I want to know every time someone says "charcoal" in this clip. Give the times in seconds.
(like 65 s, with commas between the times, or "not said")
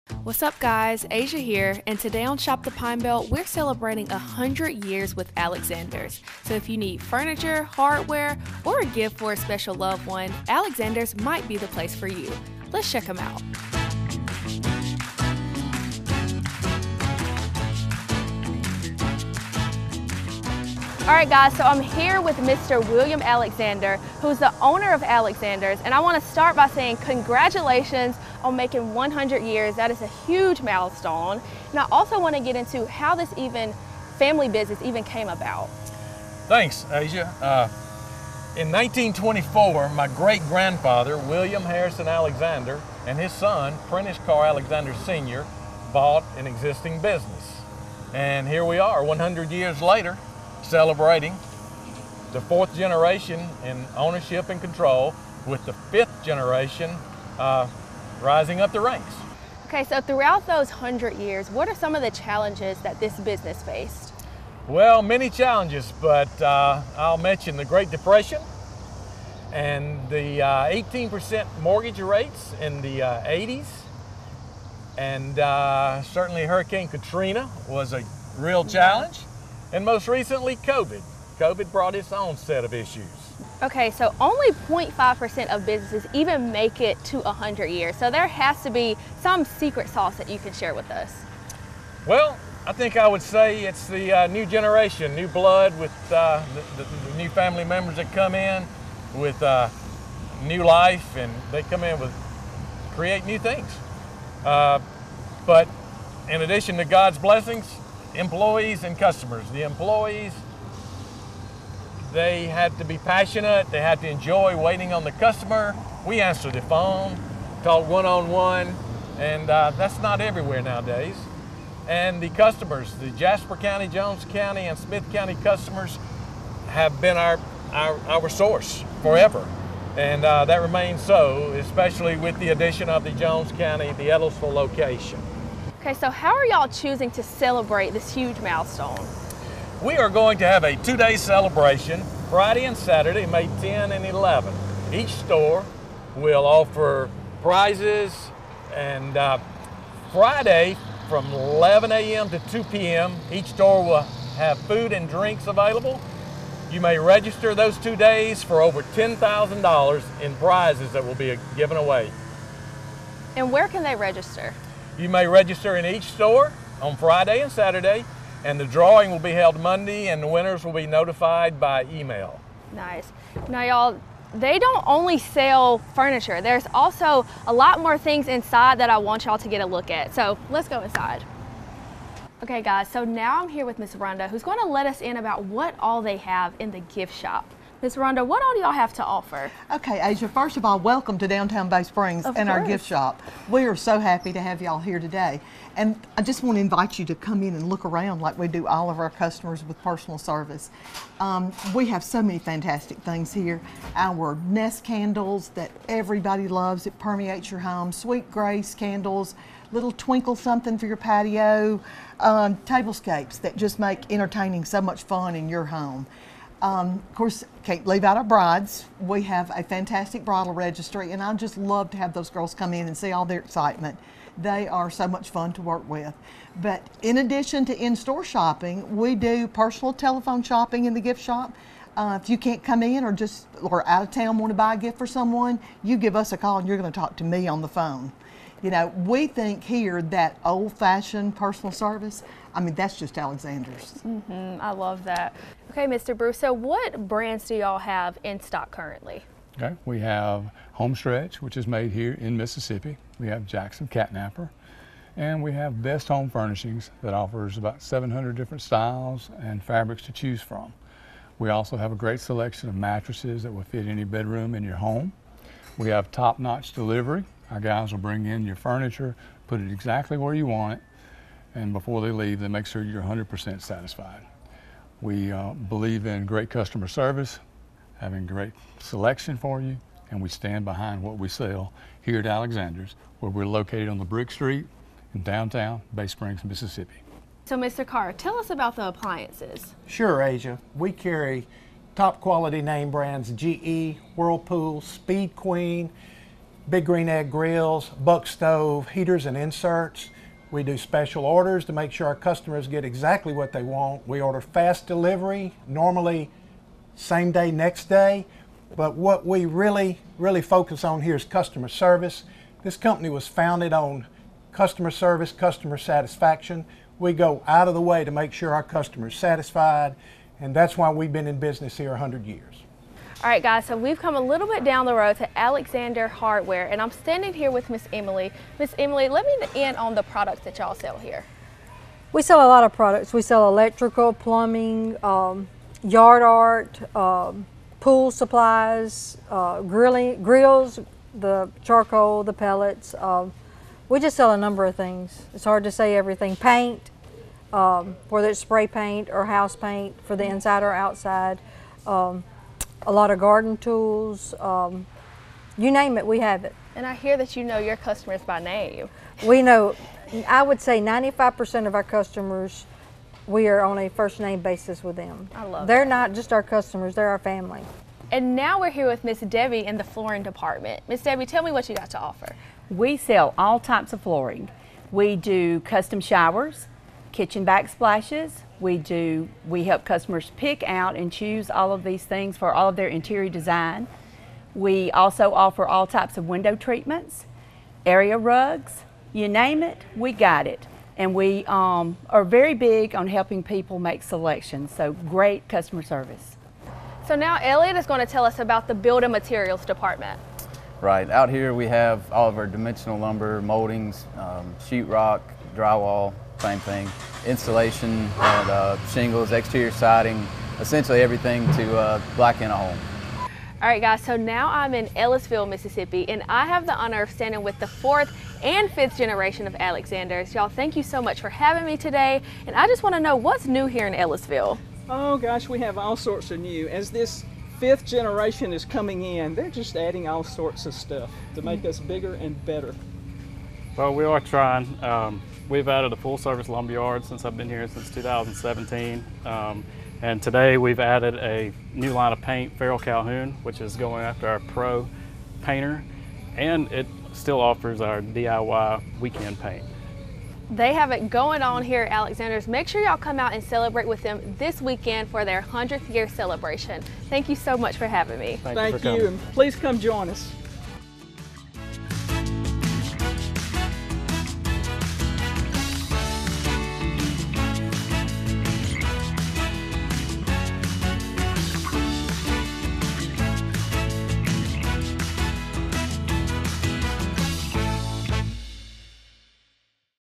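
341 s.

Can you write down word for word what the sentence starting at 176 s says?
There's also a lot more things inside that I want y'all to get a look at.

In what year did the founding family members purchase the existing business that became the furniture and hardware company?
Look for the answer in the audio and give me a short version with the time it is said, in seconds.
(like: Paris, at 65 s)
1924, at 38 s.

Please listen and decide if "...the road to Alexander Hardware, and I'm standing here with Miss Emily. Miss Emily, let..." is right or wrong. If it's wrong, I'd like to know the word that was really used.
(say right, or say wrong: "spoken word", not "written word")
right.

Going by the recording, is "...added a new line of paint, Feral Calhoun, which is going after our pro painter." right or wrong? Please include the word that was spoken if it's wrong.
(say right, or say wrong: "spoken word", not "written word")
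right.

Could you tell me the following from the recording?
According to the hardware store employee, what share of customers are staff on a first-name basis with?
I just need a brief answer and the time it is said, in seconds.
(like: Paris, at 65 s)
95%, at 360 s.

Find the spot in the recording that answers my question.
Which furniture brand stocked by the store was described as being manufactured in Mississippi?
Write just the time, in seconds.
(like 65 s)
250 s.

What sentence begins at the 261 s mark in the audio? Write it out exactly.
We also have a great selection of mattresses that will fit any bedroom in your home.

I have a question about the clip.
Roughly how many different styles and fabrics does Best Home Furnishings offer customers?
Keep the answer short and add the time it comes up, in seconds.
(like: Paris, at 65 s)
700, at 257 s.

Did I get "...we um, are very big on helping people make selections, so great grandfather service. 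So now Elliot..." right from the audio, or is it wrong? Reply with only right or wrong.
wrong.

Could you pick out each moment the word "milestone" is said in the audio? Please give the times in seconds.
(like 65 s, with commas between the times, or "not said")
30 s, 138 s.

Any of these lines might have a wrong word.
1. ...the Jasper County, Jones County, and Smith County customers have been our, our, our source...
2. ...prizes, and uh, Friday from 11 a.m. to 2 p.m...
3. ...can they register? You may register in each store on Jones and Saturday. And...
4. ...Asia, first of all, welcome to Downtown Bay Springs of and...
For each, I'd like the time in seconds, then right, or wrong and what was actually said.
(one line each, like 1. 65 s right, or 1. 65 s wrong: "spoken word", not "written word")
1. 122 s right
2. 147 s right
3. 163 s wrong: "Friday", not "Jones"
4. 190 s right.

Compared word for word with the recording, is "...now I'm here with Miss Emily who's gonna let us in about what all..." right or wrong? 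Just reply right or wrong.
wrong.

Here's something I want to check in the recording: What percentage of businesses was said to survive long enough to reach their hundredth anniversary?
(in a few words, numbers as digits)
0.5%.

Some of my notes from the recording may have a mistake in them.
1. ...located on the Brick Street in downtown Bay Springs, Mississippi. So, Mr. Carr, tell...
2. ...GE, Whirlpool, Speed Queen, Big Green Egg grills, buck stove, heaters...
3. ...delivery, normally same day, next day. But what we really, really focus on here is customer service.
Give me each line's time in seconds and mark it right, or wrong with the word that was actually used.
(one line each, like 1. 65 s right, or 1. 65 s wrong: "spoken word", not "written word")
1. 283 s right
2. 293 s right
3. 304 s right.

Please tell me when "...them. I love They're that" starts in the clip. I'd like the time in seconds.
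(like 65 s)
364 s.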